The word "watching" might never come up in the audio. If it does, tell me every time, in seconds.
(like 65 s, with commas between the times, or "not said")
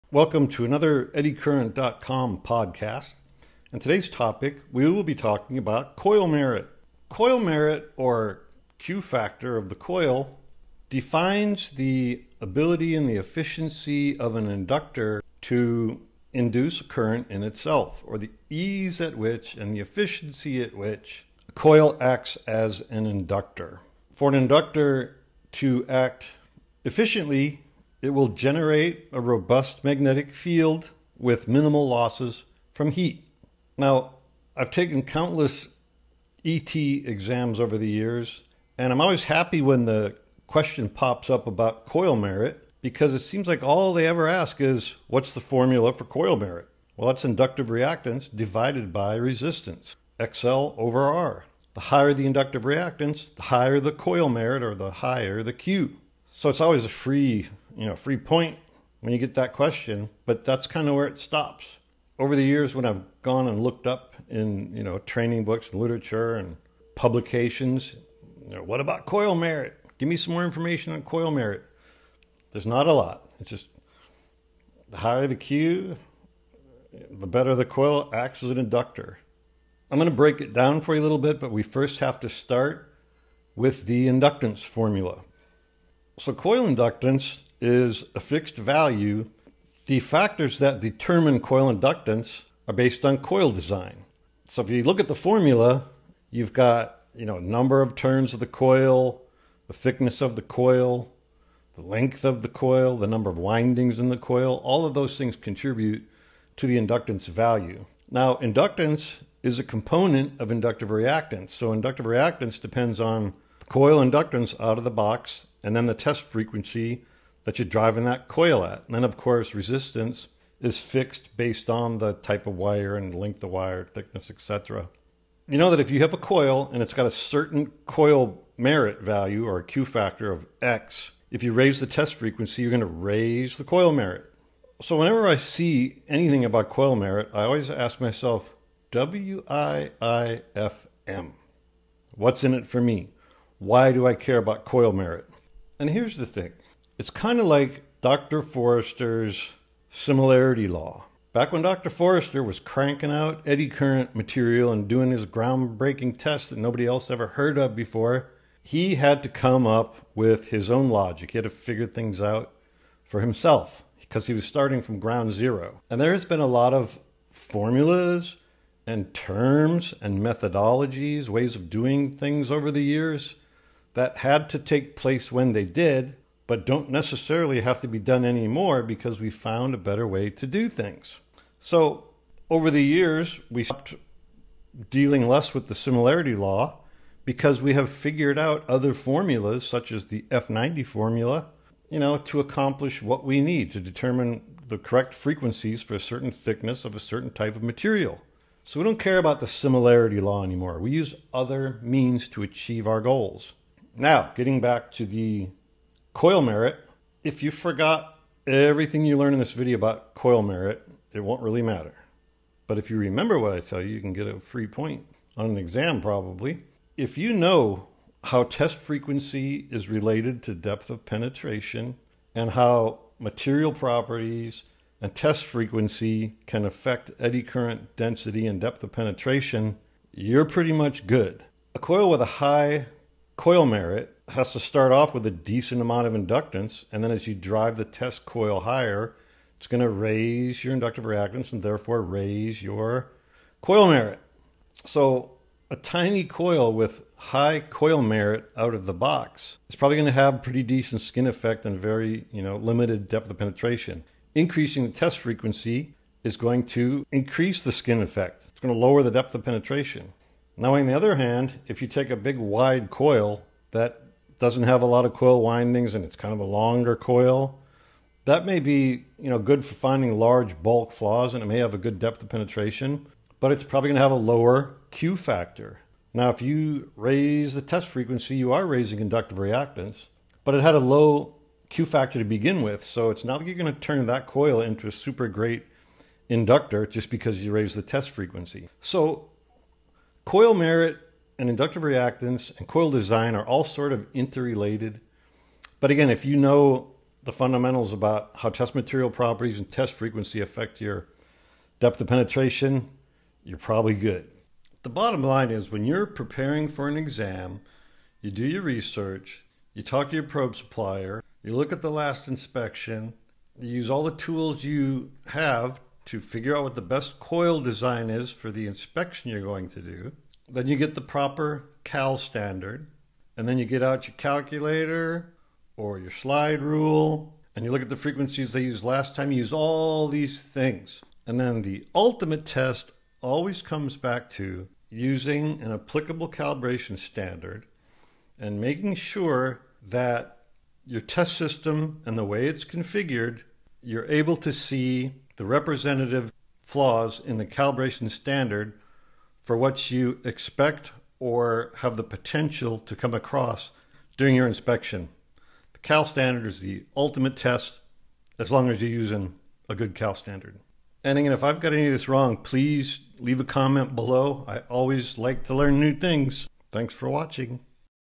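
367 s.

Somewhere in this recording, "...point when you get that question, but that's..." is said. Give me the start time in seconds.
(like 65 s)
58 s.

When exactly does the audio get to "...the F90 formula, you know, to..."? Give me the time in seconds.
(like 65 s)
190 s.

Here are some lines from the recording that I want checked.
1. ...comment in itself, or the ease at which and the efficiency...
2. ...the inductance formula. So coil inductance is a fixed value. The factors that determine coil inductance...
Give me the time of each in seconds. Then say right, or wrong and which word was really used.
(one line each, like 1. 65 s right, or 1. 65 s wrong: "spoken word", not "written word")
1. 16 s wrong: "current", not "comment"
2. 83 s right.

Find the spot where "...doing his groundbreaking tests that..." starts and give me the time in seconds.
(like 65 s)
154 s.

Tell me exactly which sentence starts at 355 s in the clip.
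The CAL standard is the ultimate test as long as you're using a good CAL standard.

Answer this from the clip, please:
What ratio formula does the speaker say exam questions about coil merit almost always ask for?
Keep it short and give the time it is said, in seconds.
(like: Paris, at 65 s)
XL over R, at 50 s.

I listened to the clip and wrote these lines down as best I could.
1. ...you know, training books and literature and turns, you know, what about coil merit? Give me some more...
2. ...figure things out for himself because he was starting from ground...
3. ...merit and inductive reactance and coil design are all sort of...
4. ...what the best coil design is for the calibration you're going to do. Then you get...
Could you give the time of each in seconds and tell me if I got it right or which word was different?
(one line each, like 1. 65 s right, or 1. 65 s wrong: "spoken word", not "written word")
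1. 64 s wrong: "publications", not "turns"
2. 161 s right
3. 290 s right
4. 316 s wrong: "inspection", not "calibration".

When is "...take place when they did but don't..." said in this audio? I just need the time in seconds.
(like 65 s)
174 s.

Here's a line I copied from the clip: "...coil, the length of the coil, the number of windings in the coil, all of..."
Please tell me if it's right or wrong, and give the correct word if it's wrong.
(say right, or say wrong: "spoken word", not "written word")
right.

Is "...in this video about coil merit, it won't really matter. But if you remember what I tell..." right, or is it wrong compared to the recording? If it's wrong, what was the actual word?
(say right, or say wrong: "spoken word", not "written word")
right.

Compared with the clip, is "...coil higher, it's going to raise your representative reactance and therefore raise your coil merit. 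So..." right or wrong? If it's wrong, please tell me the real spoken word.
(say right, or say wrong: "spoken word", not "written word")
wrong: "inductive", not "representative".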